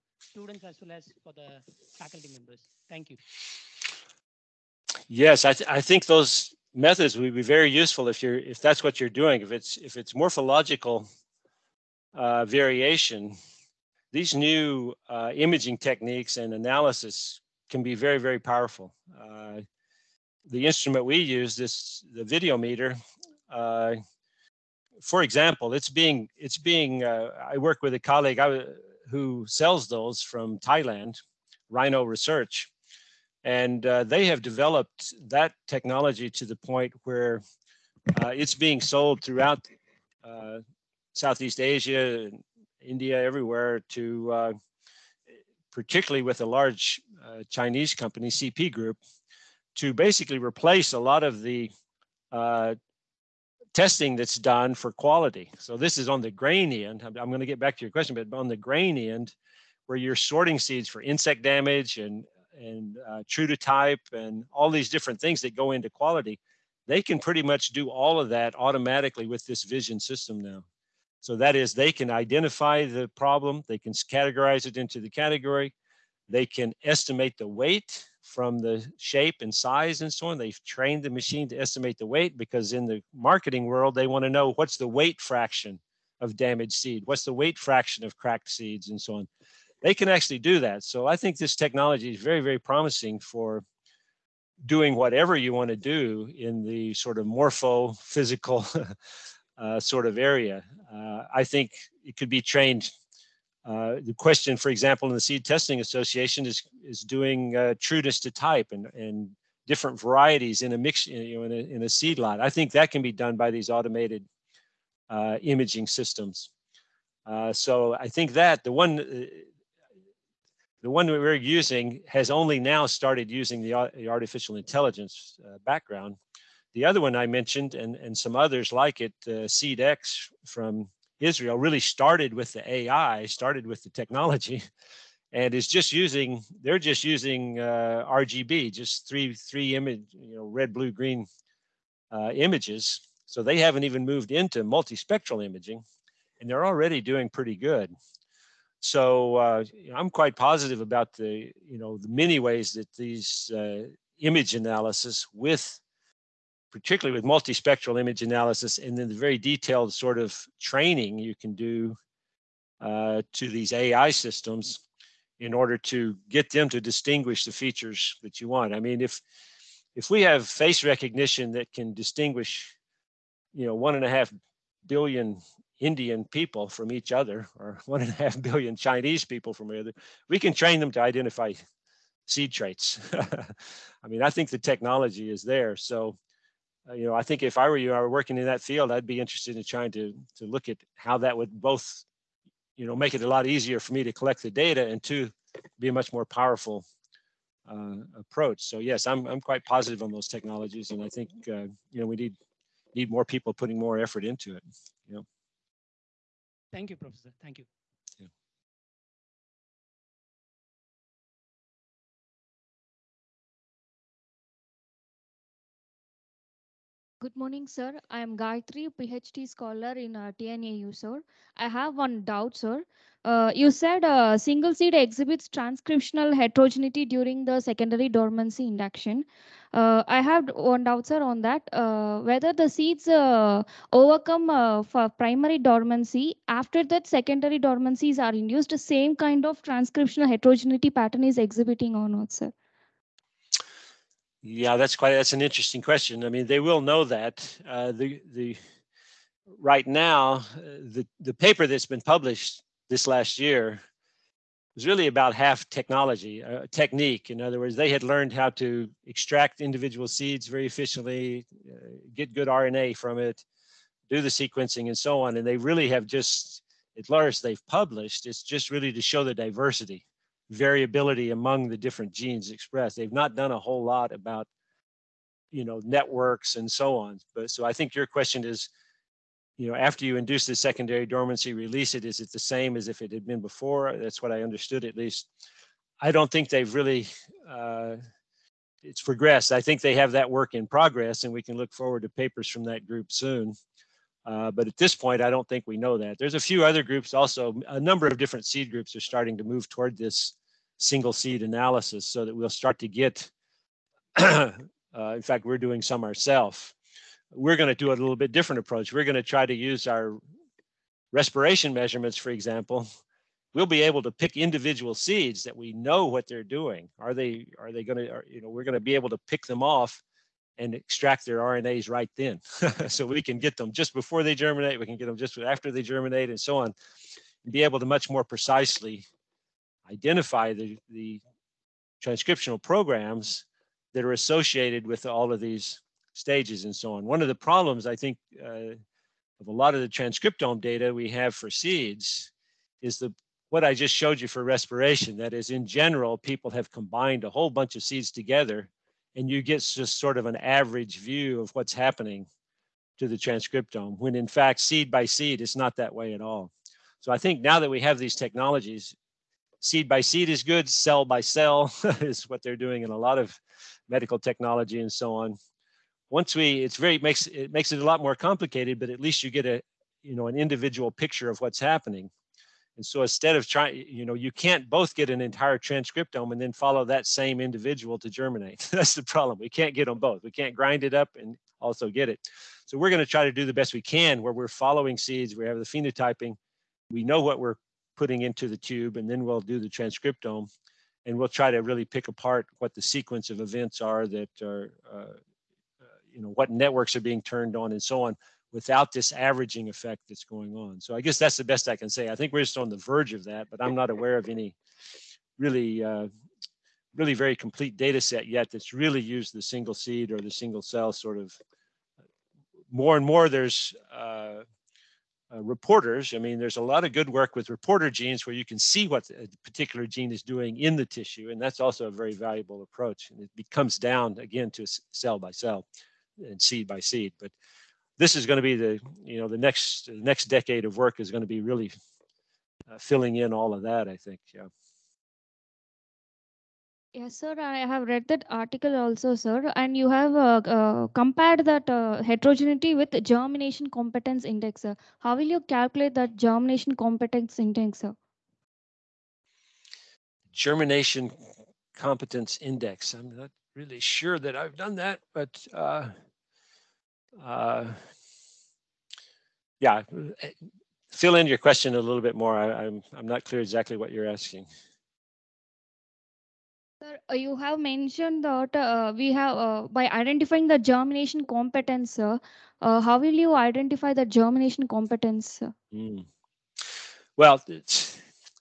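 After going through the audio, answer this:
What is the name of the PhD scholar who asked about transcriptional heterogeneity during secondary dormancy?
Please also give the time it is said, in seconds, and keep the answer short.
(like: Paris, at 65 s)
Gayatri, at 218 s.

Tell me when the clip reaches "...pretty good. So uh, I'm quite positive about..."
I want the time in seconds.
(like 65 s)
147 s.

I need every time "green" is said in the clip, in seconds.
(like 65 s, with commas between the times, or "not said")
140 s.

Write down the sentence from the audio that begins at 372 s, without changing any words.
And so instead of trying, you know, you can't both get an entire transcriptome and then follow that same individual to germinate.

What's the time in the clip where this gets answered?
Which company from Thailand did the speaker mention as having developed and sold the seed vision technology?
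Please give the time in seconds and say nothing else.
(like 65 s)
31 s.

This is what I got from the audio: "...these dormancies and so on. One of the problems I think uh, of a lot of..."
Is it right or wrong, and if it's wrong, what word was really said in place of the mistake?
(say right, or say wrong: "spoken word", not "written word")
wrong: "stages", not "dormancies".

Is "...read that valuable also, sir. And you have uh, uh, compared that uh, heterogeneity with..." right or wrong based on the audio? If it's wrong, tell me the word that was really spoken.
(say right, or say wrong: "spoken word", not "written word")
wrong: "article", not "valuable".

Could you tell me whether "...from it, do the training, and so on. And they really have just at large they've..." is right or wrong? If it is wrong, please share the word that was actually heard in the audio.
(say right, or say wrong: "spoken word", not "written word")
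wrong: "sequencing", not "training".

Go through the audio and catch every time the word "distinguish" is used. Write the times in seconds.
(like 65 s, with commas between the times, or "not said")
166 s, 171 s.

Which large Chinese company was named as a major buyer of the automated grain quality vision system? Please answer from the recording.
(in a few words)
CP Group.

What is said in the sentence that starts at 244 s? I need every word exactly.
Yeah, that's quite that's an interesting question.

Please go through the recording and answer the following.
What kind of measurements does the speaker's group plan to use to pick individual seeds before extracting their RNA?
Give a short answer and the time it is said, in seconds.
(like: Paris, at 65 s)
respiration measurements, at 311 s.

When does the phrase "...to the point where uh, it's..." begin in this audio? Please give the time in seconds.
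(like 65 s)
36 s.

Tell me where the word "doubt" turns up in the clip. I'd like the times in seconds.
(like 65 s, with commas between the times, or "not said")
222 s, 230 s.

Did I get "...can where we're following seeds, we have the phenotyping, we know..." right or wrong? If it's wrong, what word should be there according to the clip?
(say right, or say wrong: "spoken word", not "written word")
right.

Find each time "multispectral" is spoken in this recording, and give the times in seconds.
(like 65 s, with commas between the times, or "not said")
144 s, 157 s.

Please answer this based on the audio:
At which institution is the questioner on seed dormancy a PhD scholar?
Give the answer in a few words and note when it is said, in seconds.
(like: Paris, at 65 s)
TNAU, at 220 s.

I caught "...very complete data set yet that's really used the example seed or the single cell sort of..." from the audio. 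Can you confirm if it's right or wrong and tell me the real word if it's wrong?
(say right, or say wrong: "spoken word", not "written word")
wrong: "single", not "example".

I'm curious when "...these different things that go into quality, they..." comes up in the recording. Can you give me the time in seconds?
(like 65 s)
64 s.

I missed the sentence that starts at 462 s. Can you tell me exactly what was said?
I, I'm I'm not clear exactly what you're asking.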